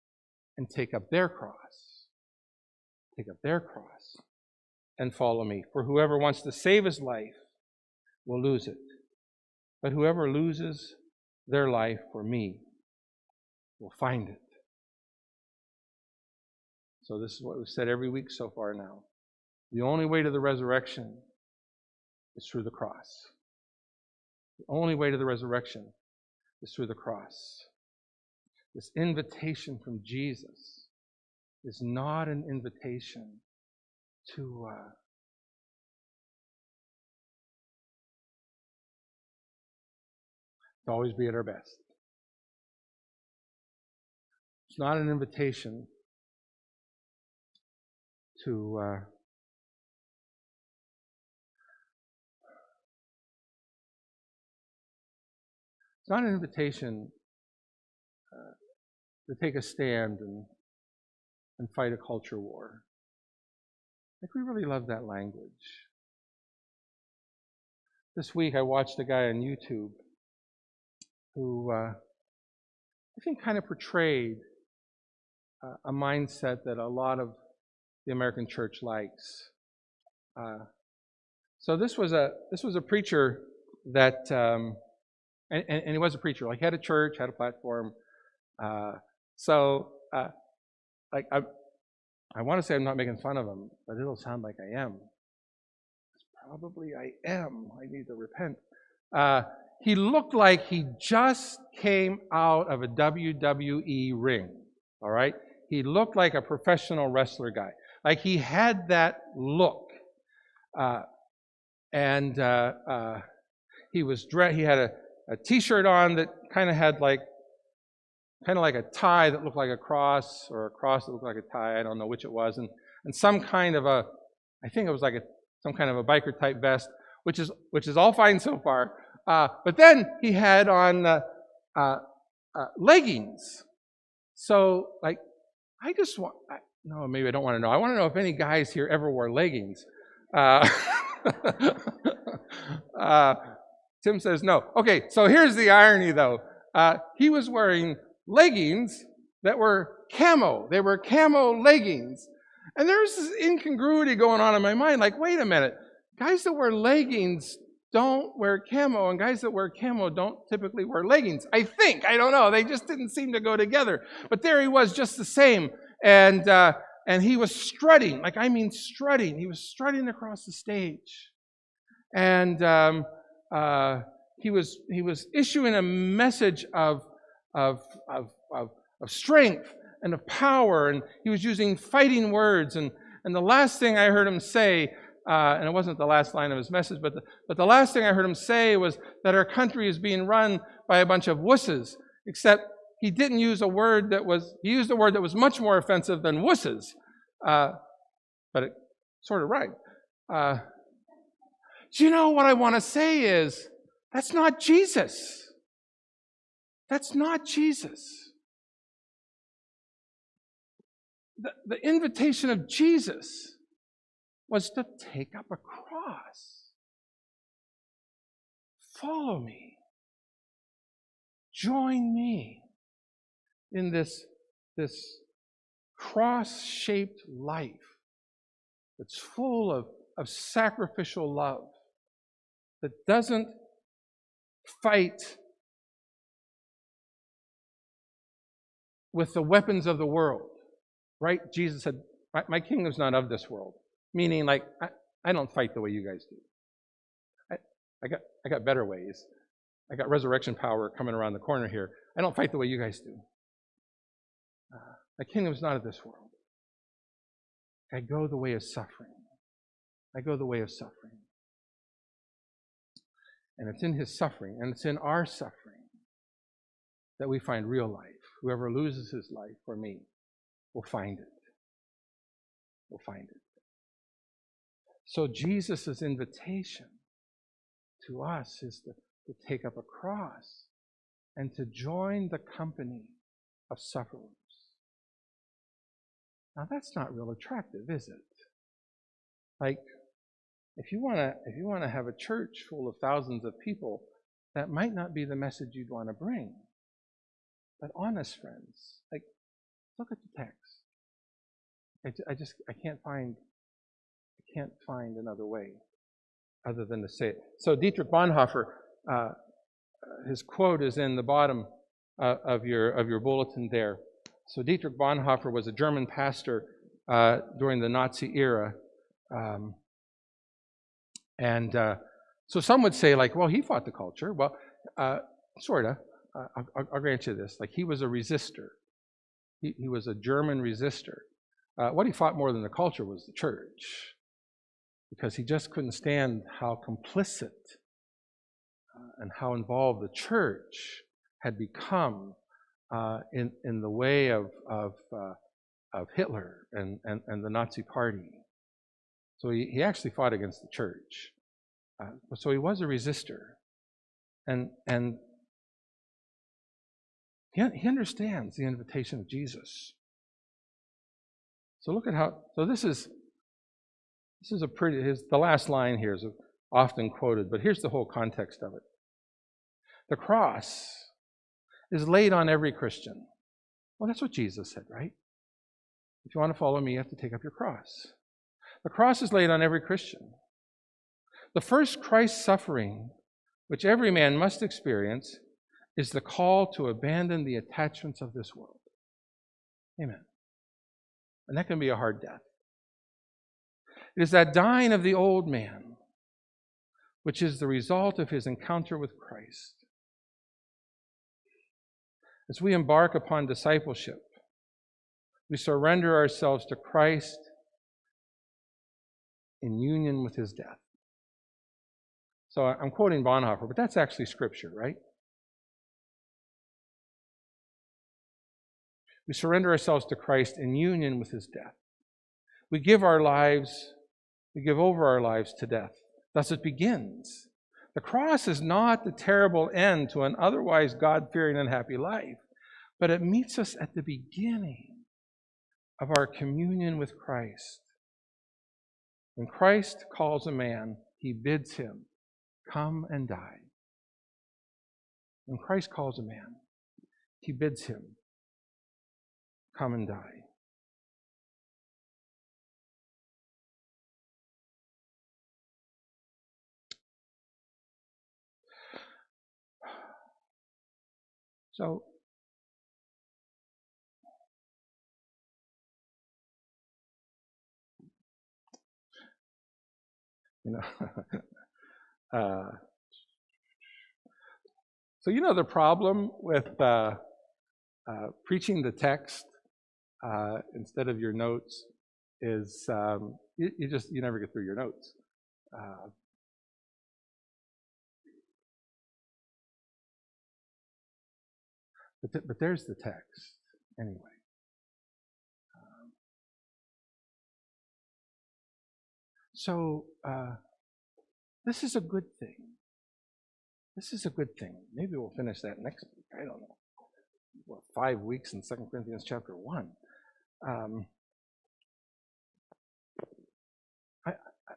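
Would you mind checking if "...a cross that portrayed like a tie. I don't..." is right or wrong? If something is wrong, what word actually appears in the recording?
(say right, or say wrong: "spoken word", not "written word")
wrong: "looked", not "portrayed".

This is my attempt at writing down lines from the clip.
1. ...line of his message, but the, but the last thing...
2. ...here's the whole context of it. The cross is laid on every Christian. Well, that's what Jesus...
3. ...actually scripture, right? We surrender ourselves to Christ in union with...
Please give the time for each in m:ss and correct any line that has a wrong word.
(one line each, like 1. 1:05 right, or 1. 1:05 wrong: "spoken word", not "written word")
1. 3:06 right
2. 6:07 right
3. 6:53 right.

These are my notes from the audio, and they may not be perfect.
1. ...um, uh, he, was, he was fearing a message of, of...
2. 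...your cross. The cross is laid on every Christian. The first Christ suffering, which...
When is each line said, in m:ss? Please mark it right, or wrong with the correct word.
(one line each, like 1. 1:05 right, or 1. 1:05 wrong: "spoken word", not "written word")
1. 2:52 wrong: "issuing", not "fearing"
2. 6:17 right.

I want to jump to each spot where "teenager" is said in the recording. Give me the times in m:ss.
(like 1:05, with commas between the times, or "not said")
not said.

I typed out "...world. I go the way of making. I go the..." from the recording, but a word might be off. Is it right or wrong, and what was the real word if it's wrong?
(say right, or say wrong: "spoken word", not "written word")
wrong: "suffering", not "making".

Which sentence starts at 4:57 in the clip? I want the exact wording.
But honest friends, like look at the text.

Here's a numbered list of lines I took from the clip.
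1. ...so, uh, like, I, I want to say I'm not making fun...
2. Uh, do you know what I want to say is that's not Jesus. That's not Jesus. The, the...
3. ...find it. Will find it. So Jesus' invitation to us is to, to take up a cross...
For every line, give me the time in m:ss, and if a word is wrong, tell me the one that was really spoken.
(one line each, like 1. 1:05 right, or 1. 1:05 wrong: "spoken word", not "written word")
1. 1:29 right
2. 3:20 right
3. 4:30 right.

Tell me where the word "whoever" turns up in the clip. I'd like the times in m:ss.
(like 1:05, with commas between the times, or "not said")
0:05, 0:09, 4:28.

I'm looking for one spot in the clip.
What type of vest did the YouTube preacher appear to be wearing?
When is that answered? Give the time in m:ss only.
2:06.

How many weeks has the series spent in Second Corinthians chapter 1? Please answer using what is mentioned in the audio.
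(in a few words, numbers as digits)
5.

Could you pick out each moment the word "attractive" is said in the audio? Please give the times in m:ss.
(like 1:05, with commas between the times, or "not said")
4:47.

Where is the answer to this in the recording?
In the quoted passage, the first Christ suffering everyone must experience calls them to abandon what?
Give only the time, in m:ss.
6:27.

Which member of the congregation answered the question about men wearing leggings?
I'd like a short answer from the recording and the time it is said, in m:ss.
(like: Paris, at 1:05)
Tim, at 2:24.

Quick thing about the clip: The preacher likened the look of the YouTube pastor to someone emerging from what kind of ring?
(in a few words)
WWE ring.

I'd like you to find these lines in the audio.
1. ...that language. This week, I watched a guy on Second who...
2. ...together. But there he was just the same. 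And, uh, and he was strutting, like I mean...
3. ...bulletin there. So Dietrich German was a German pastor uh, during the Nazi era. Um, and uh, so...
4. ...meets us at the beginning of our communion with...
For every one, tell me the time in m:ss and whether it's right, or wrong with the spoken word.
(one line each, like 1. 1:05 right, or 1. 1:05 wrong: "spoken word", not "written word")
1. 1:04 wrong: "YouTube", not "Second"
2. 2:43 right
3. 5:13 wrong: "Bonhoeffer", not "German"
4. 7:13 right.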